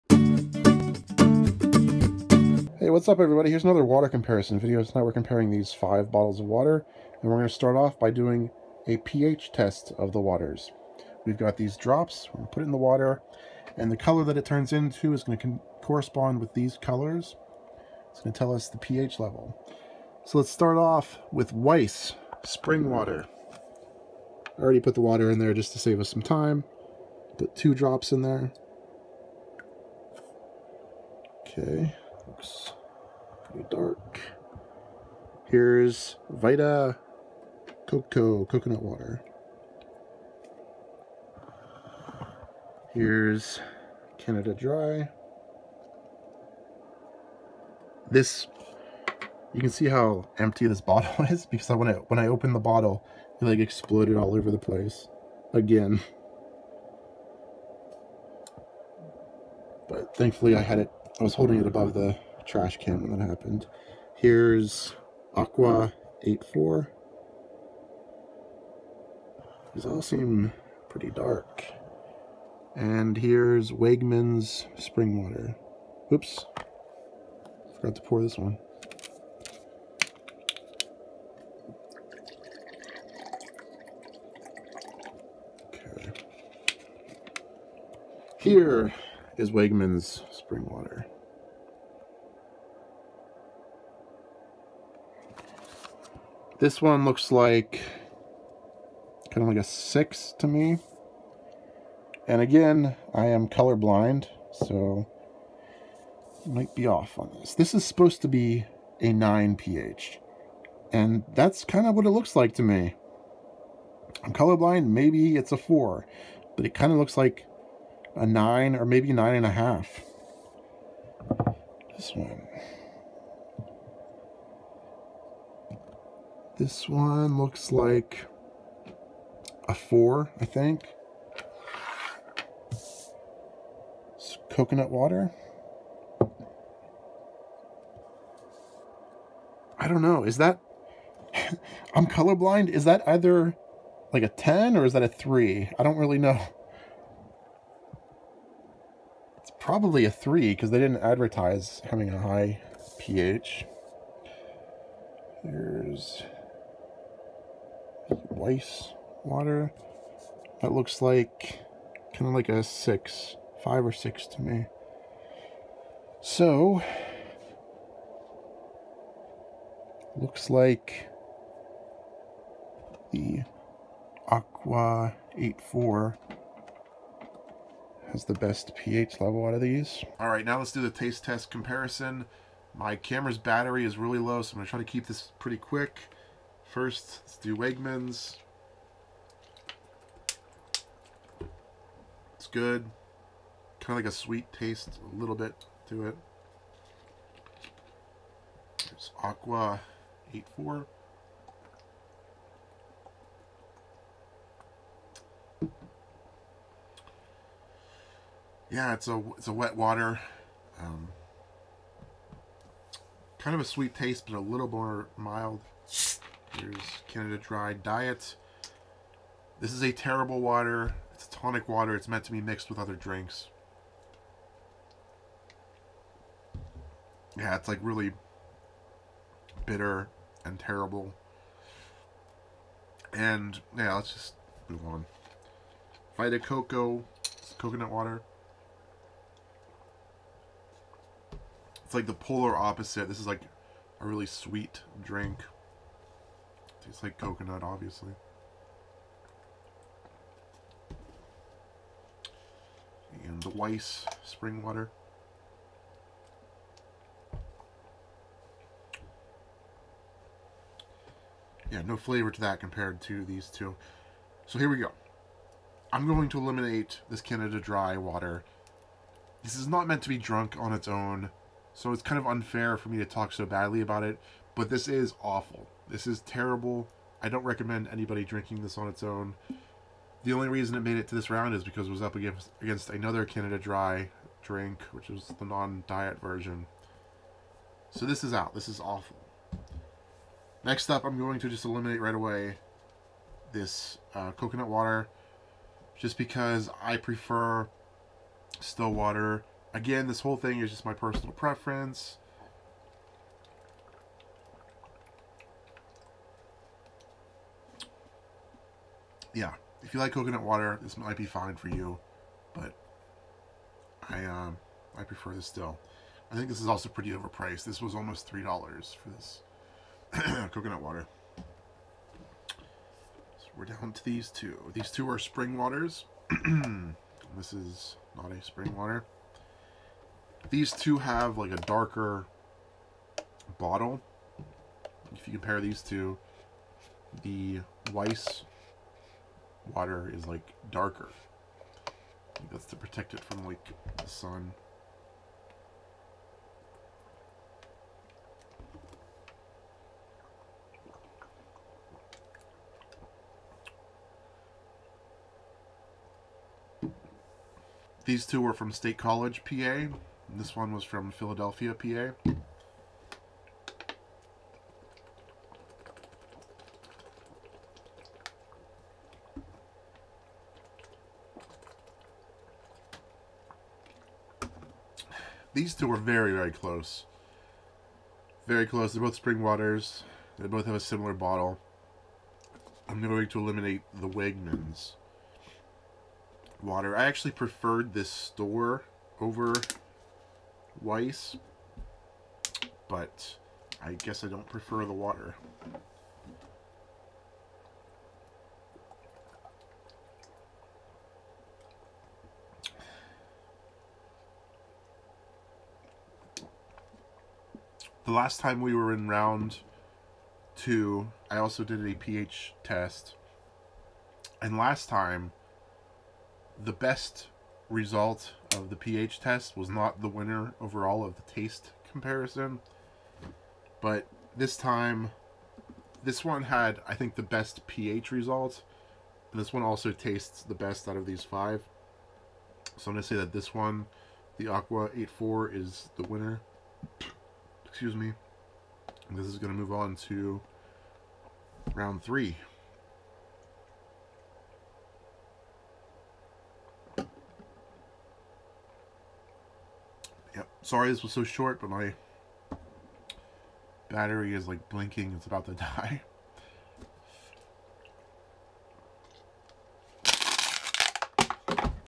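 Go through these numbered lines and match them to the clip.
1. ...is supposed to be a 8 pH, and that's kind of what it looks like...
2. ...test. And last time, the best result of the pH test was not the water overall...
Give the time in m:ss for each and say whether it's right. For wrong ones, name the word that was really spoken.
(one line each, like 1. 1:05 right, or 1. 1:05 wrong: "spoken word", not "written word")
1. 1:47 wrong: "9", not "8"
2. 6:52 wrong: "winner", not "water".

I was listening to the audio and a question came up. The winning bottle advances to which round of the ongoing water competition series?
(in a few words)
round three.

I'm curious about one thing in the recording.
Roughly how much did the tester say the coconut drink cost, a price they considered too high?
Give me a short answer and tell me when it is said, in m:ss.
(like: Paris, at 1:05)
almost 3 dollars, at 5:17.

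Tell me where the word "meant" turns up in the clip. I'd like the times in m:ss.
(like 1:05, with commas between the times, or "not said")
3:42, 4:29.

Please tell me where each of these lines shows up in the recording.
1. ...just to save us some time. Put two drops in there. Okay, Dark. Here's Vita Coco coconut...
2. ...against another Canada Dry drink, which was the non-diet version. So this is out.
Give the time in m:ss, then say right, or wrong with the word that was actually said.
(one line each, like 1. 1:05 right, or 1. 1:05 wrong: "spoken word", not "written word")
1. 0:25 right
2. 4:42 right.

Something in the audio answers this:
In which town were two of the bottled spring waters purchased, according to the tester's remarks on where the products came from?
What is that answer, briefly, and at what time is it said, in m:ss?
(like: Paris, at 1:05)
State College, PA, at 5:58.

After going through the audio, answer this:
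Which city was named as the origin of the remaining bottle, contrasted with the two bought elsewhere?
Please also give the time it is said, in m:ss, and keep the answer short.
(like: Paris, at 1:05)
Philadelphia, at 6:01.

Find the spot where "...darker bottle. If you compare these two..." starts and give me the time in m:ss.
5:31.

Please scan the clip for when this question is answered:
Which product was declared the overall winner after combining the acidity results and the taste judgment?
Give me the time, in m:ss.
7:14.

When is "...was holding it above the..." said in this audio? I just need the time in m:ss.
1:01.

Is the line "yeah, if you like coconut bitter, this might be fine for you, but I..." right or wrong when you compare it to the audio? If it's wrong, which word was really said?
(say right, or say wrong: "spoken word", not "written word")
wrong: "water", not "bitter".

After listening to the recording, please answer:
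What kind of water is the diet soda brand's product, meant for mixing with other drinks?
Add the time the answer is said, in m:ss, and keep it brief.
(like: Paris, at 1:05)
tonic water, at 3:41.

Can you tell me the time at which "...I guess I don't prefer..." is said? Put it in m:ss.
6:33.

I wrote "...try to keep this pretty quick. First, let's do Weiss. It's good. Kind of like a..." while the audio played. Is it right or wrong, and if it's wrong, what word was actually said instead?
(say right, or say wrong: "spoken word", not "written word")
wrong: "Wegmans", not "Weiss".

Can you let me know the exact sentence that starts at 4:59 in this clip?
Again, this whole thing is just my personal preference.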